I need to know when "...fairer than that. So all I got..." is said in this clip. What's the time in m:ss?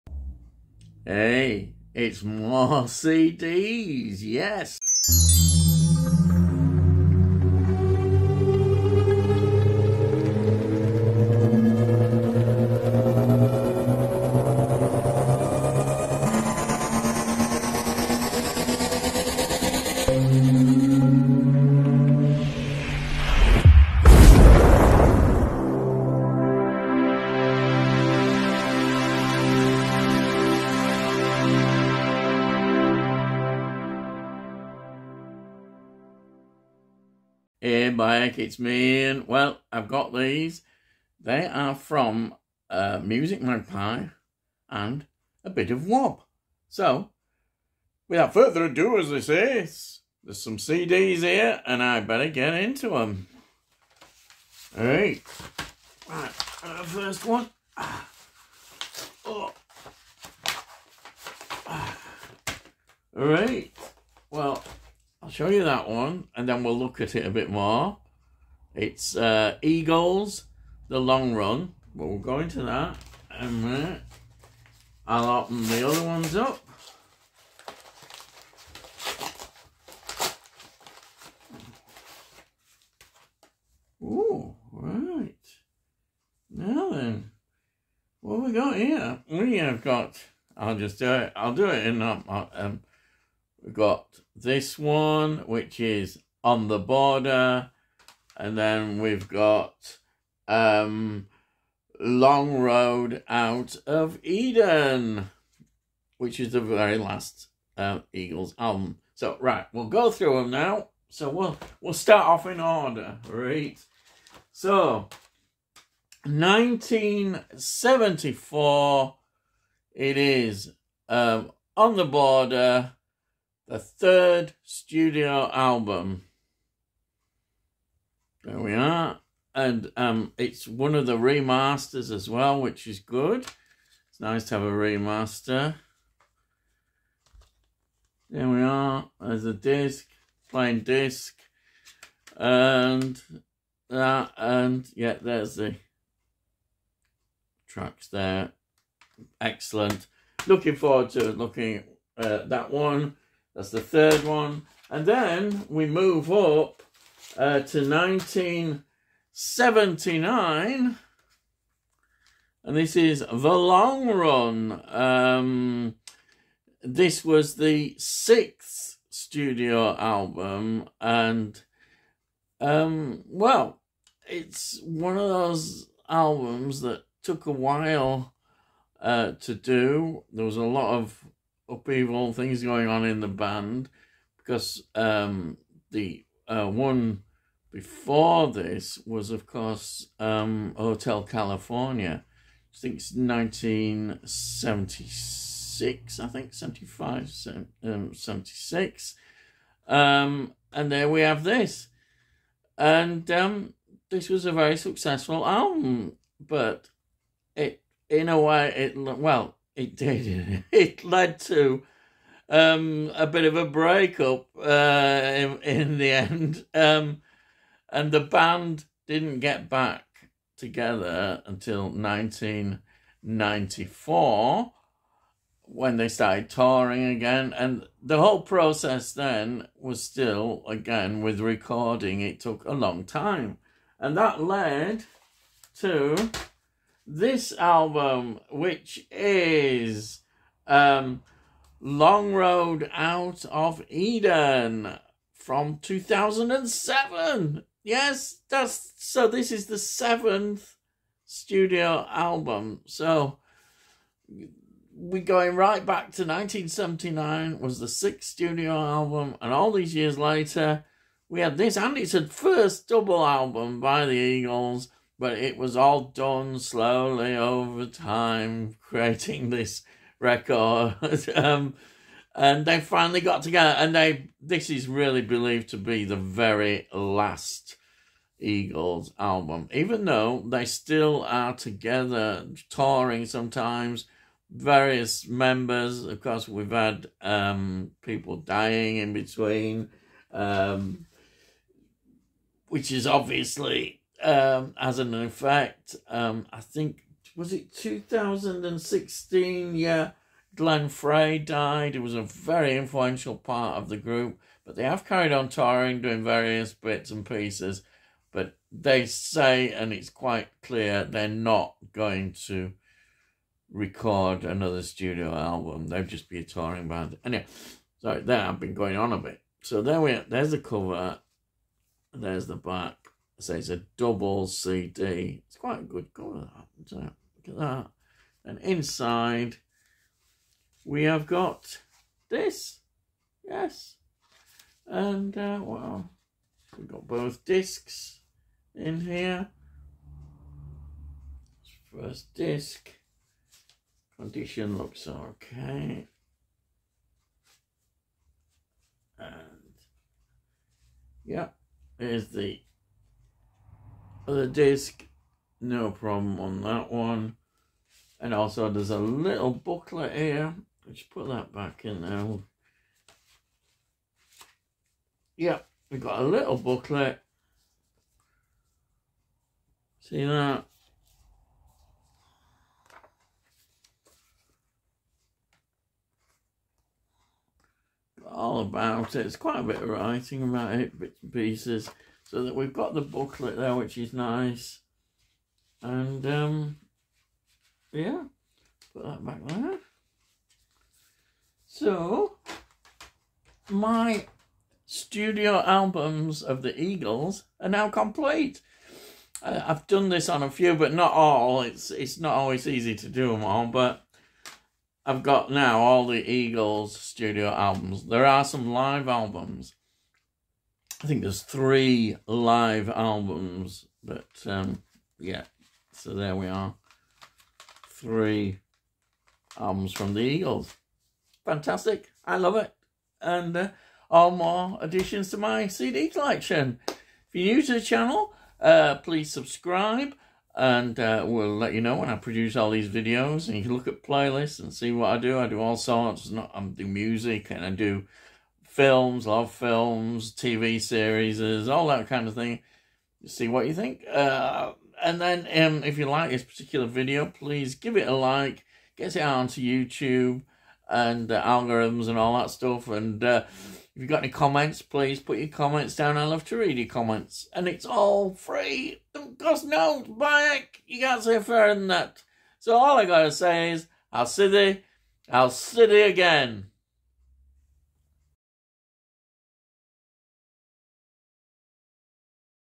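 7:41.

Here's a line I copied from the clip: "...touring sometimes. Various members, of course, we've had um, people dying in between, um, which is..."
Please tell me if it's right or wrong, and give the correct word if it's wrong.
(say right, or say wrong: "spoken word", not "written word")
right.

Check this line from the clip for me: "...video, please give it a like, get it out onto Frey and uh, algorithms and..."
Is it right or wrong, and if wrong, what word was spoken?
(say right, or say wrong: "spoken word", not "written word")
wrong: "YouTube", not "Frey".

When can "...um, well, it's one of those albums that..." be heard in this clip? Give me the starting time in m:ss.
2:52.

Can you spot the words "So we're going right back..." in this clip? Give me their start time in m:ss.
4:12.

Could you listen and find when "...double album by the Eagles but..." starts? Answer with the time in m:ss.
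4:22.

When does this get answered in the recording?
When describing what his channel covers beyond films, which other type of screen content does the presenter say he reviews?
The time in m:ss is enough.
7:20.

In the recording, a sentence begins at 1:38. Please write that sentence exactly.
And then we've got um, Long Road Out of Eden, which is the very last uh, Eagles album.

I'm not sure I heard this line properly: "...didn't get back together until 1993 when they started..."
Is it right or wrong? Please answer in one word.
wrong.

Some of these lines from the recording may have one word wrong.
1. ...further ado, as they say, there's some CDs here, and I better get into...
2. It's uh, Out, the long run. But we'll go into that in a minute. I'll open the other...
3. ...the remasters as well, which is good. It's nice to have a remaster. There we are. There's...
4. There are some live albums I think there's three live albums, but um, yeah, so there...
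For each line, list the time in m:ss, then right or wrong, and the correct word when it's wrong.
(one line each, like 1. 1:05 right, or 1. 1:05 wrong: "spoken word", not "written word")
1. 0:48 right
2. 1:08 wrong: "Eagles", not "Out"
3. 2:11 right
4. 6:48 right.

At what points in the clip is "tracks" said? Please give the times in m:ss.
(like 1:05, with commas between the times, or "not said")
2:27.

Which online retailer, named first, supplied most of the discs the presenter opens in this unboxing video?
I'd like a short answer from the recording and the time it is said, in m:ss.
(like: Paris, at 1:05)
Music Magpie, at 0:43.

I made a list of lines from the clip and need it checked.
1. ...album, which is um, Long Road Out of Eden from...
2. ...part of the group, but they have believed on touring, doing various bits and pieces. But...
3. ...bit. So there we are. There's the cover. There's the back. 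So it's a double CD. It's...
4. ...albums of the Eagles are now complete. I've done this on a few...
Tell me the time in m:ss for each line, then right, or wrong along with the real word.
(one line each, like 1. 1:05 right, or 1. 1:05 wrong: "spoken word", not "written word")
1. 3:57 right
2. 5:03 wrong: "carried", not "believed"
3. 5:19 right
4. 6:35 right.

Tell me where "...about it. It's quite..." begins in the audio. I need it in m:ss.
6:18.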